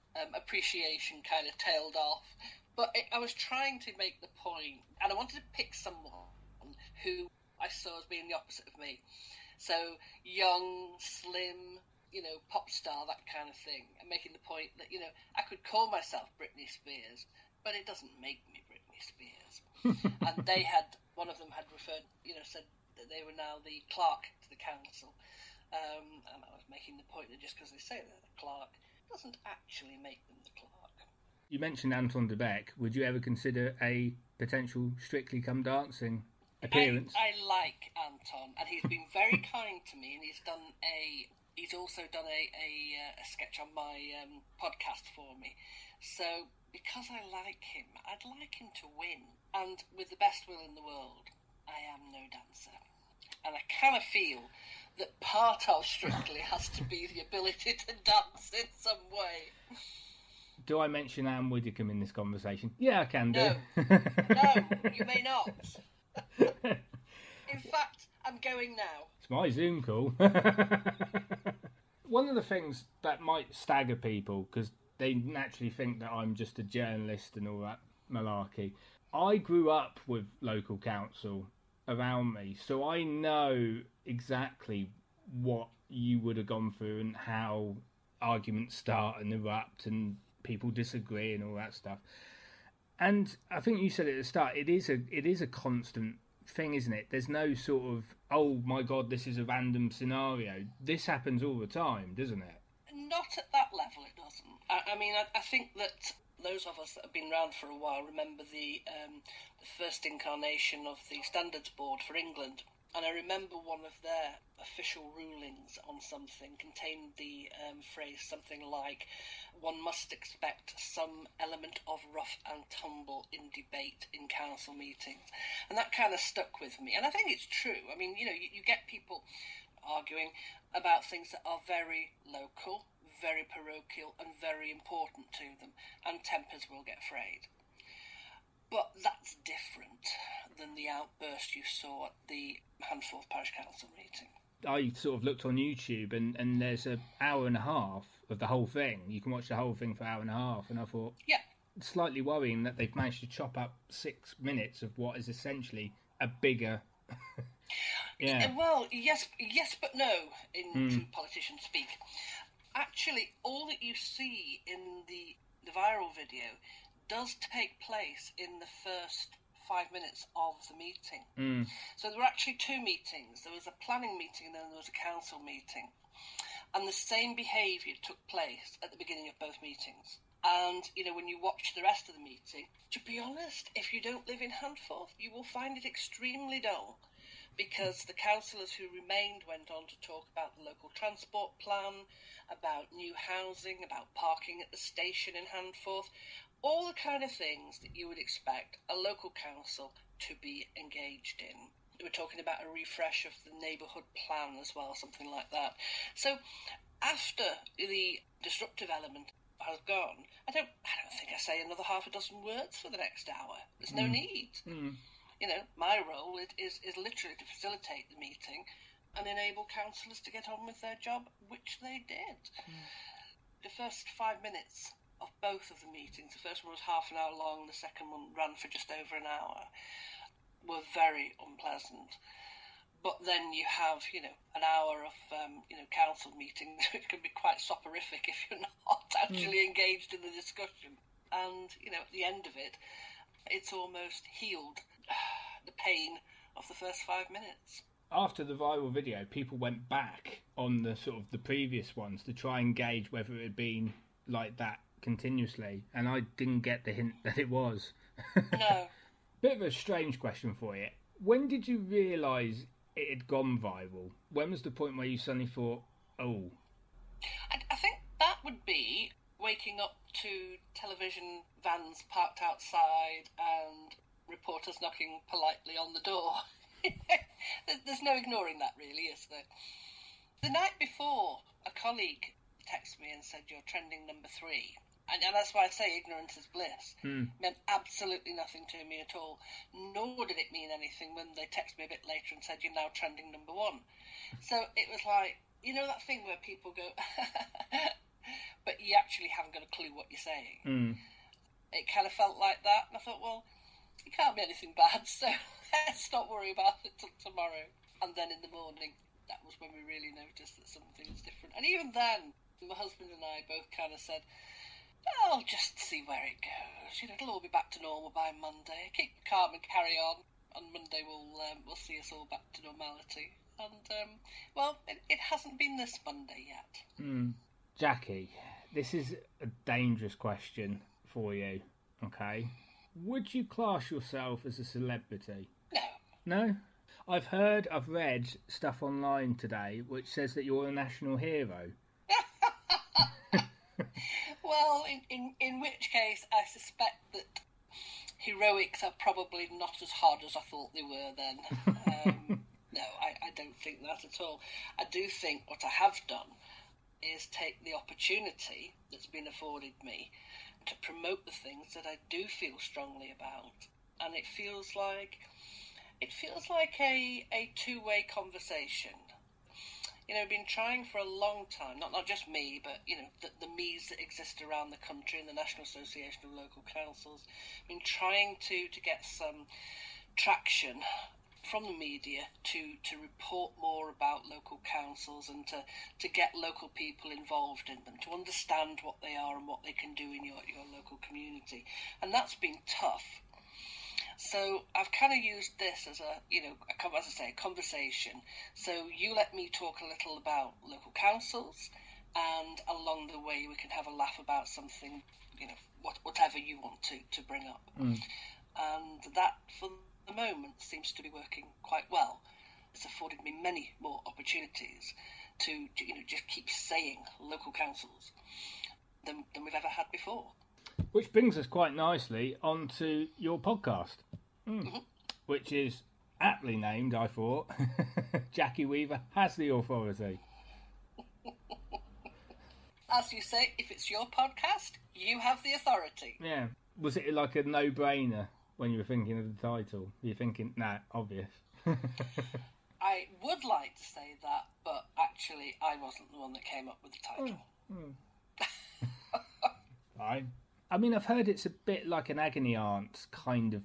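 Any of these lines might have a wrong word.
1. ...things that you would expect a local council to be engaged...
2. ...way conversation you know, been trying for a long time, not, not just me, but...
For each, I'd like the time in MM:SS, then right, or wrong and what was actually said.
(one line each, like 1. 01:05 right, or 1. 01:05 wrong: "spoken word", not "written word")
1. 03:17 right
2. 06:07 right.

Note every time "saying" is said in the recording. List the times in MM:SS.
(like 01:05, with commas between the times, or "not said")
05:00, 06:56.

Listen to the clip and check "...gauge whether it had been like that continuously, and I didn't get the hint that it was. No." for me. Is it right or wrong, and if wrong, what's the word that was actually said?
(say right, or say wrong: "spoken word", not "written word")
right.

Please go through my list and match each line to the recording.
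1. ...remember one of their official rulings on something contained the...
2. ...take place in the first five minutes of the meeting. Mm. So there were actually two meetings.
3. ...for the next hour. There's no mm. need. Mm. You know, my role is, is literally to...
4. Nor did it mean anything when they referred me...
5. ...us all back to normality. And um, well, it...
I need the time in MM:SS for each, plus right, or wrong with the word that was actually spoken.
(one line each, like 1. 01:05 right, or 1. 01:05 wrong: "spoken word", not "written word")
1. 01:53 right
2. 02:47 right
3. 03:32 right
4. 04:49 wrong: "texted", not "referred"
5. 05:21 right.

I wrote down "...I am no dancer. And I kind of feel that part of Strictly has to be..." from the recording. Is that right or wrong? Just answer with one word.
right.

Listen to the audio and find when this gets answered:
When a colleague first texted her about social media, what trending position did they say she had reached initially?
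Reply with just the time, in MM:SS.
04:44.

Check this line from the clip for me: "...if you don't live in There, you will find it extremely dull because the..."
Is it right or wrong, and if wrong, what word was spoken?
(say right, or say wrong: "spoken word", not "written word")
wrong: "Handforth", not "There".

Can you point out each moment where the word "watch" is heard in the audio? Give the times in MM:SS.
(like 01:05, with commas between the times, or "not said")
02:29, 03:01.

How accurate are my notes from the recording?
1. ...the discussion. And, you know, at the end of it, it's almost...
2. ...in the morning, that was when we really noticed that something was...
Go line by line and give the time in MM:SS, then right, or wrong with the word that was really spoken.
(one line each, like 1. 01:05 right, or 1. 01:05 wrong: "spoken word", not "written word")
1. 04:00 right
2. 05:08 right.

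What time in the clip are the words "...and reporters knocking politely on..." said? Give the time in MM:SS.
04:33.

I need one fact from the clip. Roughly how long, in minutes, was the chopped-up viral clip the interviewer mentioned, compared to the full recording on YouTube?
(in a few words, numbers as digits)
6.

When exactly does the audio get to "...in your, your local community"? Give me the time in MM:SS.
06:30.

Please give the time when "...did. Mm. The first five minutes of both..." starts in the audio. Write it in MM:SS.
03:42.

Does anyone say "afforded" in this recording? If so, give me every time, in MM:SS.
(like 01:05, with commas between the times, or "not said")
05:59, 06:52.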